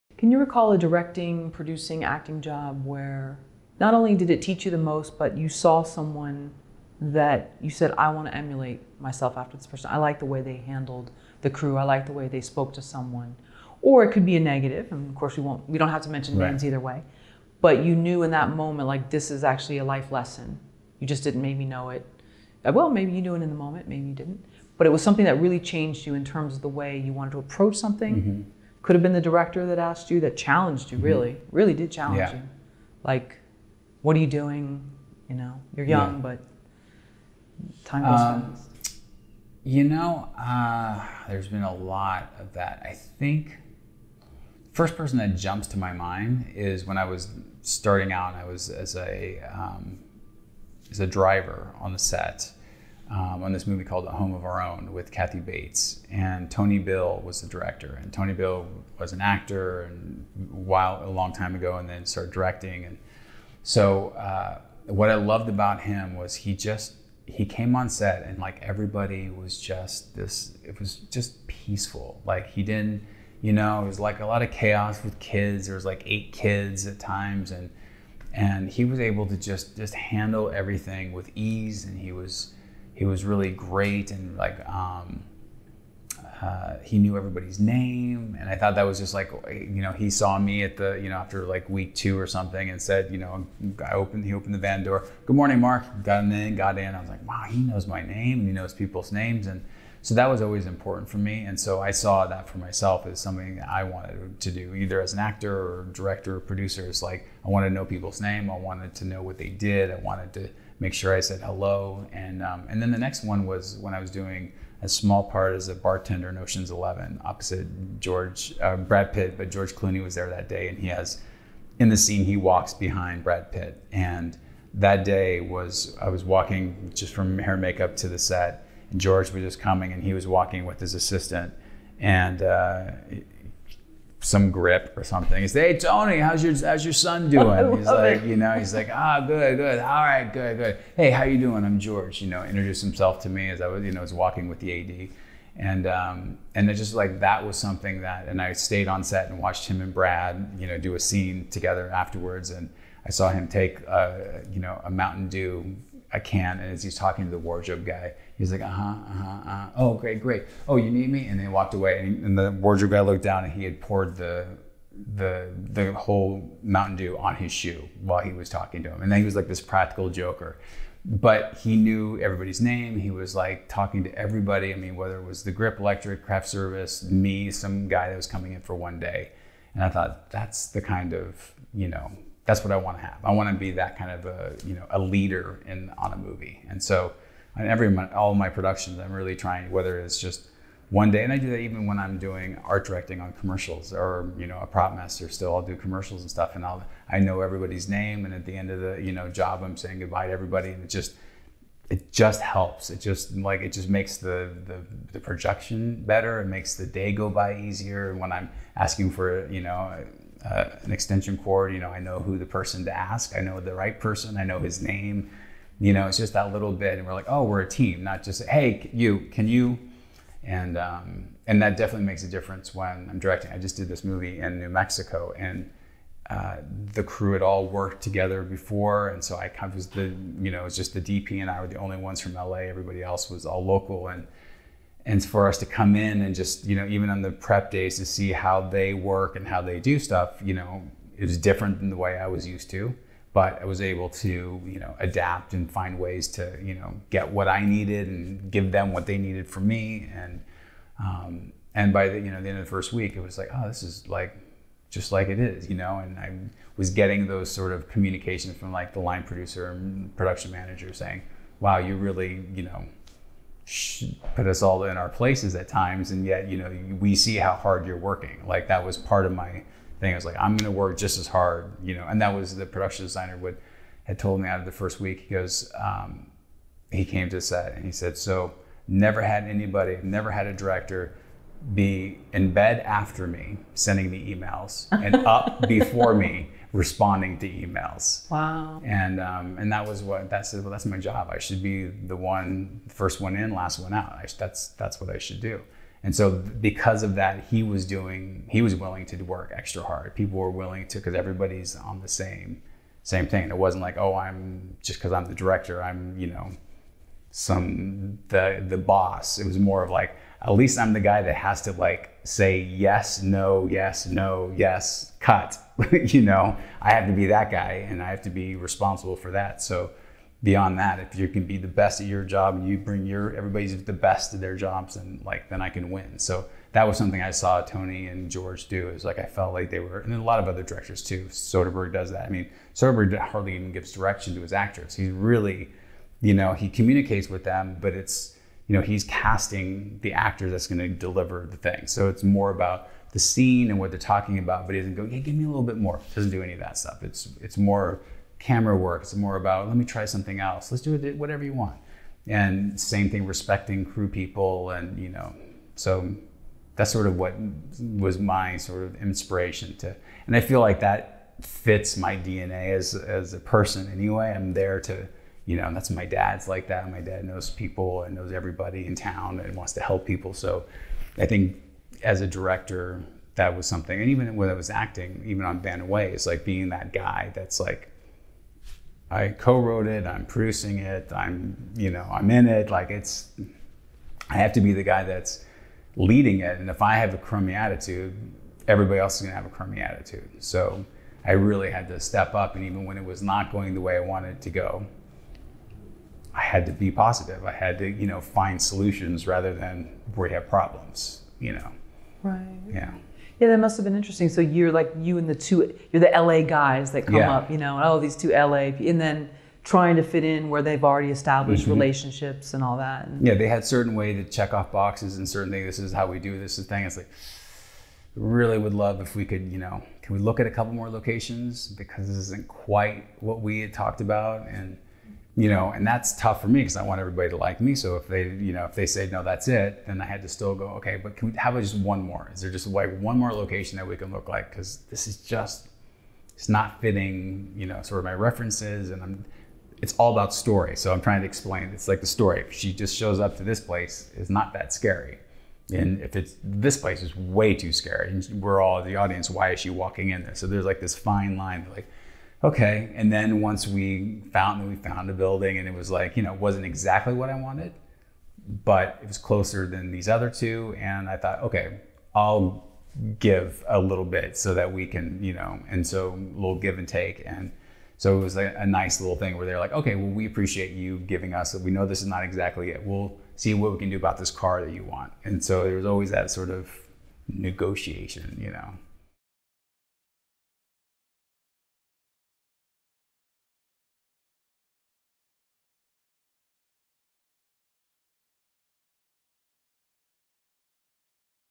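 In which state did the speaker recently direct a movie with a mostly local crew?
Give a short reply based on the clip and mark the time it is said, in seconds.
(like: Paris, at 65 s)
New Mexico, at 224 s.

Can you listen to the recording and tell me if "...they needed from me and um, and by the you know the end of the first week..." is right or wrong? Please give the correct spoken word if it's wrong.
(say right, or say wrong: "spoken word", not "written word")
right.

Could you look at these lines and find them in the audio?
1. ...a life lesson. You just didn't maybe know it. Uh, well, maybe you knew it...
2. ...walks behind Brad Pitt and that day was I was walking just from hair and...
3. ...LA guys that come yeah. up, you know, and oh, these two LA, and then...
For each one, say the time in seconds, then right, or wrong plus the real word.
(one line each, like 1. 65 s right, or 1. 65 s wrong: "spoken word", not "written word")
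1. 19 s right
2. 122 s right
3. 406 s right.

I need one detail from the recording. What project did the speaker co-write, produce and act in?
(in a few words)
Bannen Way.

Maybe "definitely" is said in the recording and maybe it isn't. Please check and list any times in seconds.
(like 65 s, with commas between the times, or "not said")
221 s.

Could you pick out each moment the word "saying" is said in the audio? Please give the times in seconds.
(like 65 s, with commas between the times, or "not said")
199 s, 260 s.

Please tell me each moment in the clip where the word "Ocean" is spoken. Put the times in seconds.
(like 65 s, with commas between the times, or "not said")
116 s.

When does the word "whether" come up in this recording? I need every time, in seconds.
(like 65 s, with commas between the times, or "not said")
174 s, 189 s.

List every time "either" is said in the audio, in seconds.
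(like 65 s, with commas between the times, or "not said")
16 s, 104 s.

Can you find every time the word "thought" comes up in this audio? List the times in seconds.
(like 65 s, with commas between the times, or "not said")
88 s, 179 s, 461 s.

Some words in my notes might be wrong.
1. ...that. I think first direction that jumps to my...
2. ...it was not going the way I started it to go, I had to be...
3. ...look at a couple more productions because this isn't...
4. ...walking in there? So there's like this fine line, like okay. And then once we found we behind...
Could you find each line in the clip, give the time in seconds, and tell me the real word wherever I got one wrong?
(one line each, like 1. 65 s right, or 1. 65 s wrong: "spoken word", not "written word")
1. 42 s wrong: "person", not "direction"
2. 392 s wrong: "wanted", not "started"
3. 420 s wrong: "locations", not "productions"
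4. 449 s wrong: "found", not "behind".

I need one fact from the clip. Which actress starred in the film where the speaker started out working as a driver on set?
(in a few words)
Kathy Bates.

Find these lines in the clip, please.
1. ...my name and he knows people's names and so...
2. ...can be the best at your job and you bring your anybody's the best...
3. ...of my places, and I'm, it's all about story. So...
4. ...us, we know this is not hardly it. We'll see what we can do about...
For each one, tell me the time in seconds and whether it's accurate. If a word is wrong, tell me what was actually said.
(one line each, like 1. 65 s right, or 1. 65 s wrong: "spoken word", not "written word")
1. 97 s right
2. 321 s wrong: "everybody", not "anybody"
3. 437 s wrong: "references", not "places"
4. 471 s wrong: "exactly", not "hardly".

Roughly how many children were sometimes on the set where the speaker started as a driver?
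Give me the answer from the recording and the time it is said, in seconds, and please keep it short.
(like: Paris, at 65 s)
8, at 76 s.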